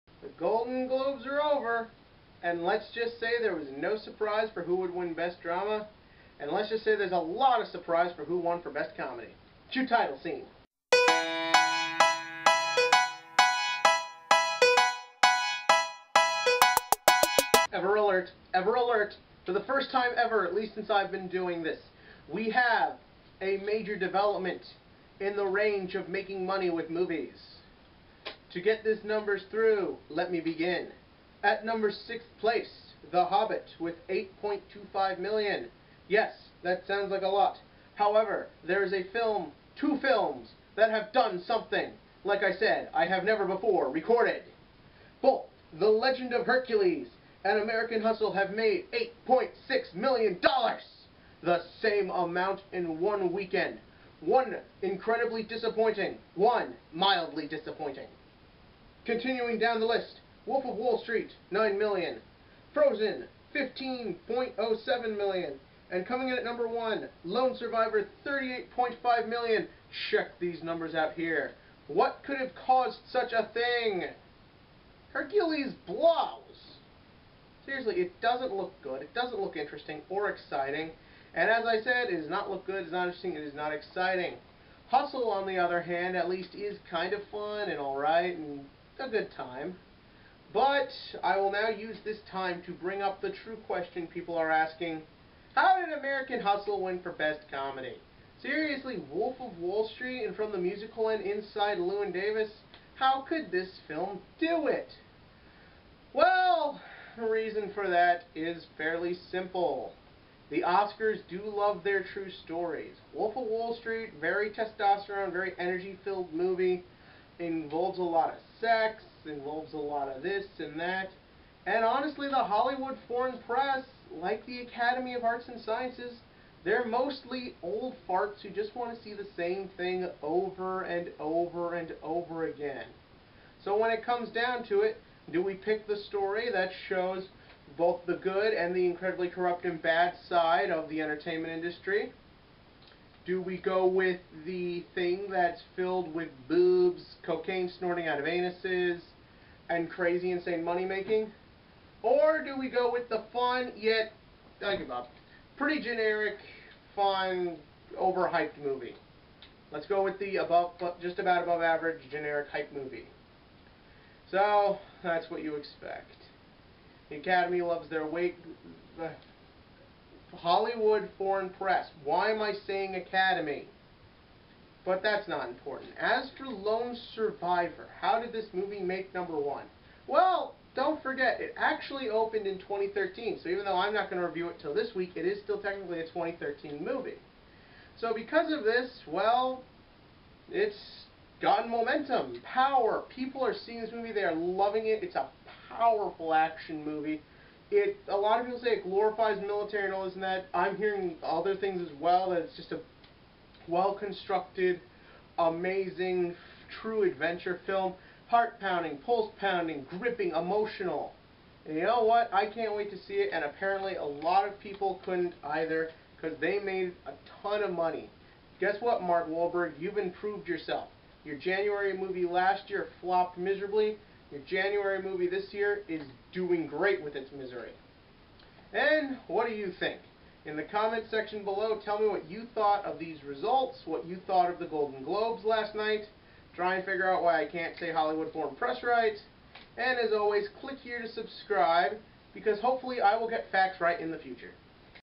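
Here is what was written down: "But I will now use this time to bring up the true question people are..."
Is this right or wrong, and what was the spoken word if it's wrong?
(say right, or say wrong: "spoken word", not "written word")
right.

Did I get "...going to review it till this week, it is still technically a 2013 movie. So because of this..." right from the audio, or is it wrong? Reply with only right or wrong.
right.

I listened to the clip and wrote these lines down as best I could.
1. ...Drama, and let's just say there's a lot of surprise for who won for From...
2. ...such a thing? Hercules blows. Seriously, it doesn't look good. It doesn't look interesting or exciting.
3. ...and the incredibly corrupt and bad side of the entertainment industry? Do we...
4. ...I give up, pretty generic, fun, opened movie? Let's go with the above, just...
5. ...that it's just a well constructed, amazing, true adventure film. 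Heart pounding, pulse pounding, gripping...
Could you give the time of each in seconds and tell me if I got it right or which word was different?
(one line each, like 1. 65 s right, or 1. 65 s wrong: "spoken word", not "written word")
1. 5 s wrong: "Best", not "From"
2. 73 s right
3. 138 s right
4. 154 s wrong: "overhyped", not "opened"
5. 202 s right.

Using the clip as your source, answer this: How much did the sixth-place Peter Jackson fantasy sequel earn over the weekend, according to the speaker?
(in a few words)
$8.25 million.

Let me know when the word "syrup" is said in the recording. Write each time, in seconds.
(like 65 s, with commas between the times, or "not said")
not said.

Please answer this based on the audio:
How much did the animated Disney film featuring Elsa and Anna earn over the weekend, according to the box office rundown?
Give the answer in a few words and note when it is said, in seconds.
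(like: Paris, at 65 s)
$15.07 million, at 63 s.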